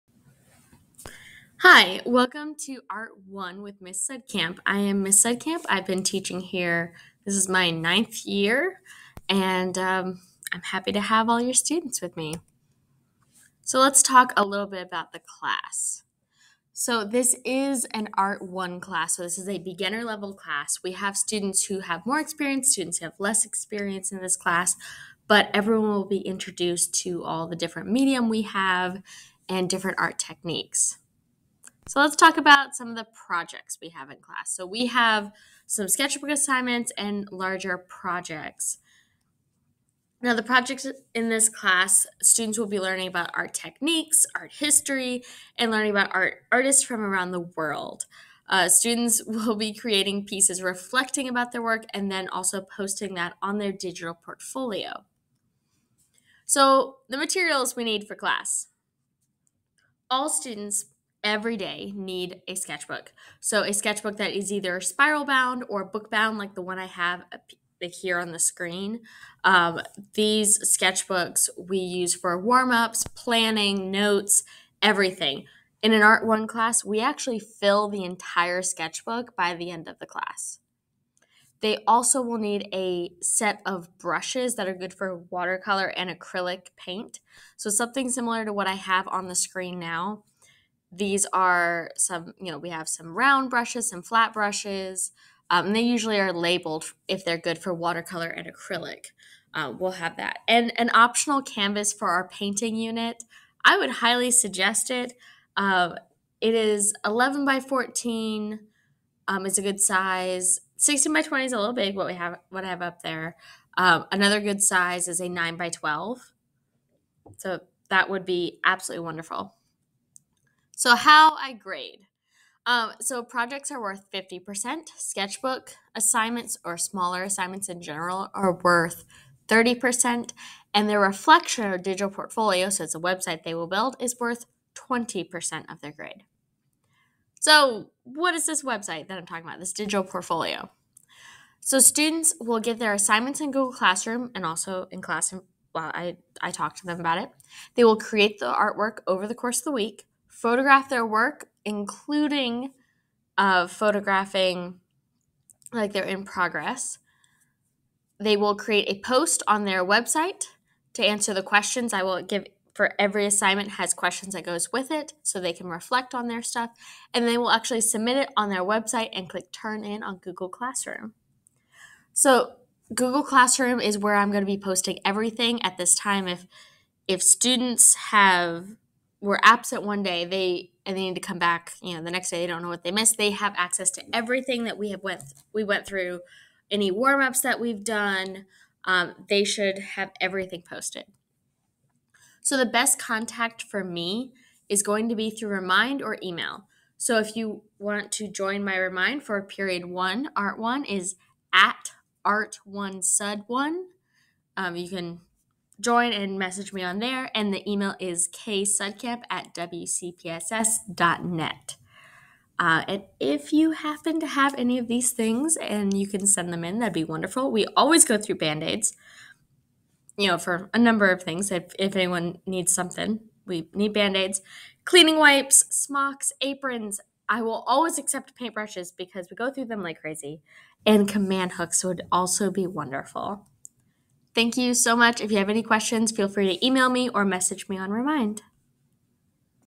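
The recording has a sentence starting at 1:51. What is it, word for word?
What we have, what I have up there.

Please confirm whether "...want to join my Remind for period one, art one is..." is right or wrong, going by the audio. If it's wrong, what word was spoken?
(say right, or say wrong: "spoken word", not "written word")
right.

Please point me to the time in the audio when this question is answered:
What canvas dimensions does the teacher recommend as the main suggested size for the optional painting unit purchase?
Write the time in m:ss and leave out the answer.
1:47.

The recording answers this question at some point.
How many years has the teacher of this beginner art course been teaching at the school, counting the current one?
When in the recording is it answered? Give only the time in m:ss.
0:07.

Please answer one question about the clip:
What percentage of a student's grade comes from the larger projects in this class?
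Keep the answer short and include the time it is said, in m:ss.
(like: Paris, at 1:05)
50%, at 2:04.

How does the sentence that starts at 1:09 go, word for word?
Um, these sketchbooks we use for warm ups, planning, notes, everything.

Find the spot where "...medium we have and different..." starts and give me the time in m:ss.
0:27.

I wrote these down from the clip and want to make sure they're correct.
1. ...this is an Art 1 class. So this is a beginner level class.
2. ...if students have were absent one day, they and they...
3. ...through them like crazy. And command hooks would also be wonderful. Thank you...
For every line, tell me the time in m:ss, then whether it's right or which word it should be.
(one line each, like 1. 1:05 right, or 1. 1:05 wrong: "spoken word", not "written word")
1. 0:17 right
2. 2:57 right
3. 3:49 right.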